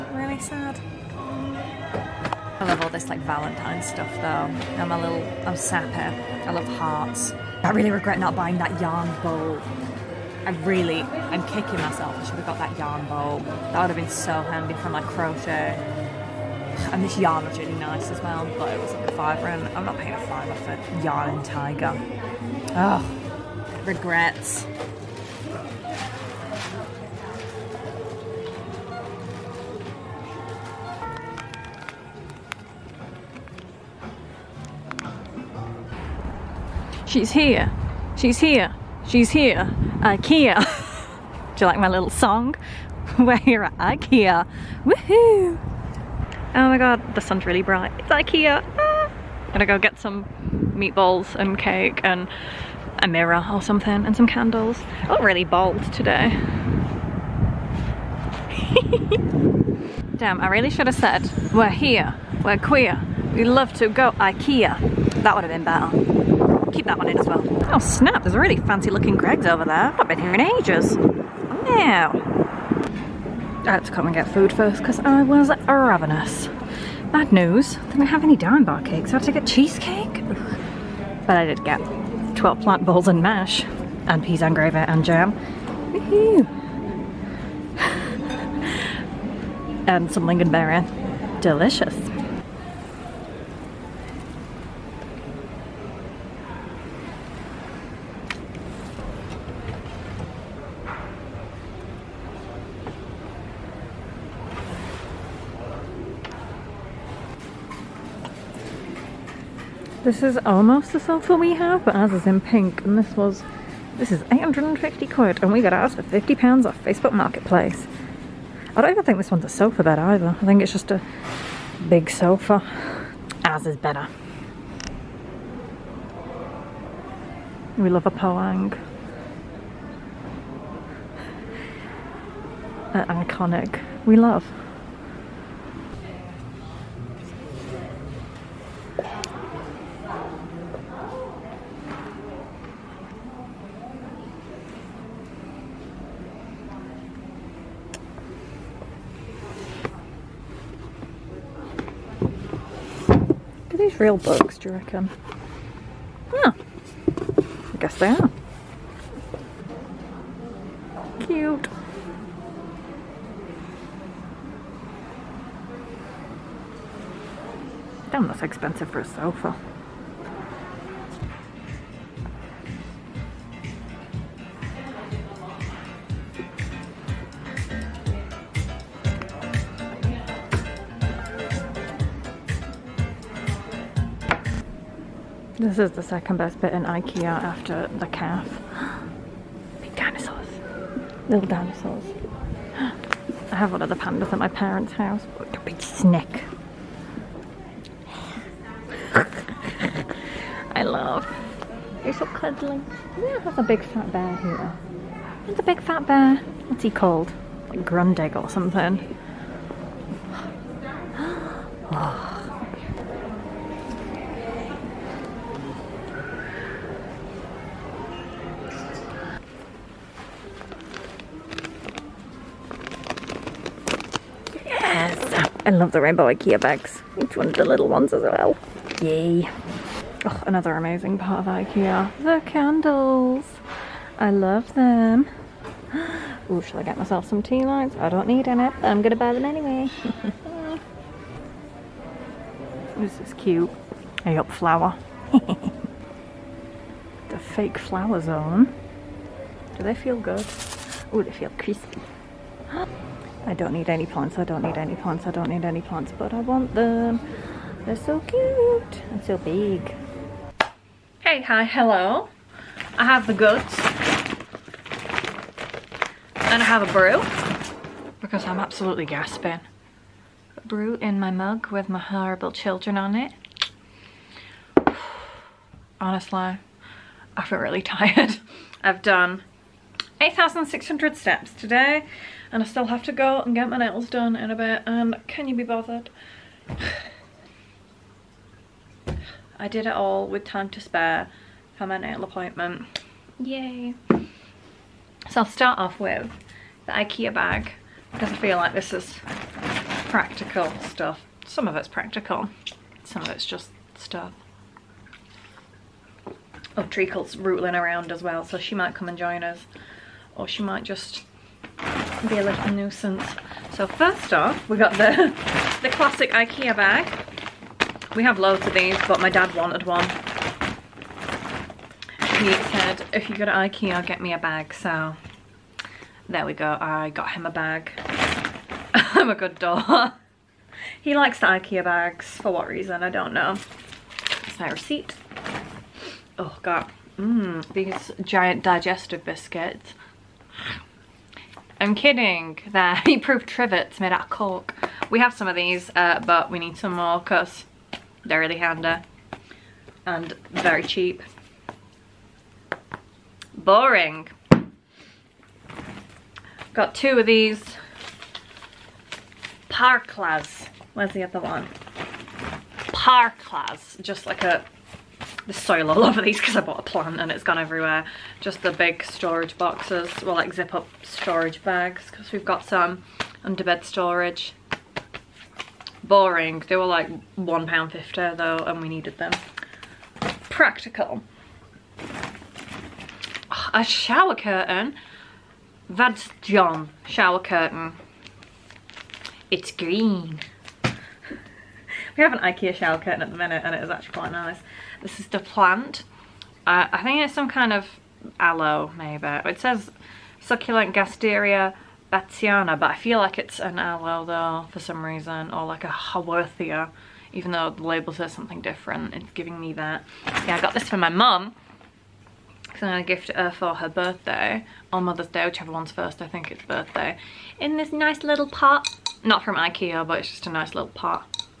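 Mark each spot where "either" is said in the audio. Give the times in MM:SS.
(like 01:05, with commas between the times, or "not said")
01:59.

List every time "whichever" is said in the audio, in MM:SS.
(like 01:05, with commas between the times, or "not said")
06:55.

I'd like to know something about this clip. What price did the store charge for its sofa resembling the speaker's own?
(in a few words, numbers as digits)
850 quid.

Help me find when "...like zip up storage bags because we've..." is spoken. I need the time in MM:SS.
06:10.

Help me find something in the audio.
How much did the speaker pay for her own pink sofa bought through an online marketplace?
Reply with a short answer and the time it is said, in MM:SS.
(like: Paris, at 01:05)
50 pounds, at 01:56.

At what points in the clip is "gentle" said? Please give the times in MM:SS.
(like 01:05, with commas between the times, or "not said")
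not said.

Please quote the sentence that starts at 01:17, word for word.
Bad news, didn't have any Daim bar cakes.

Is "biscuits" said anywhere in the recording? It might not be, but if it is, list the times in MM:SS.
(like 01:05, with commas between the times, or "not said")
05:39.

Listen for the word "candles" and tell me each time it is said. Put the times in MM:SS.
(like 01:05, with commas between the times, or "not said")
00:54, 03:52.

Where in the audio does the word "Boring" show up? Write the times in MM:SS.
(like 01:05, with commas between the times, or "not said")
05:53, 06:16.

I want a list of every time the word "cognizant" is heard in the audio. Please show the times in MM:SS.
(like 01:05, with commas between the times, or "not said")
not said.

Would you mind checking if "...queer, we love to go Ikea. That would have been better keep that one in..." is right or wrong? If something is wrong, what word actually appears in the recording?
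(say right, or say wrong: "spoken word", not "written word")
right.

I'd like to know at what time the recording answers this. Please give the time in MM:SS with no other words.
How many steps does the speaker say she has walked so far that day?
04:40.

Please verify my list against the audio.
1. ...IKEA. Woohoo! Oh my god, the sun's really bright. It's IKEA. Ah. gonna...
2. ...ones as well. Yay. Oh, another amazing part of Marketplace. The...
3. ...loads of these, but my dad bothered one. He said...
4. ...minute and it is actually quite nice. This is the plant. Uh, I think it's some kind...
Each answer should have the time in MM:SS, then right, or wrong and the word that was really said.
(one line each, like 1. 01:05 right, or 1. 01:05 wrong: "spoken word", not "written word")
1. 00:43 right
2. 03:47 wrong: "IKEA", not "Marketplace"
3. 05:18 wrong: "wanted", not "bothered"
4. 06:33 right.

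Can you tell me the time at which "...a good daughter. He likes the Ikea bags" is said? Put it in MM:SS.
05:29.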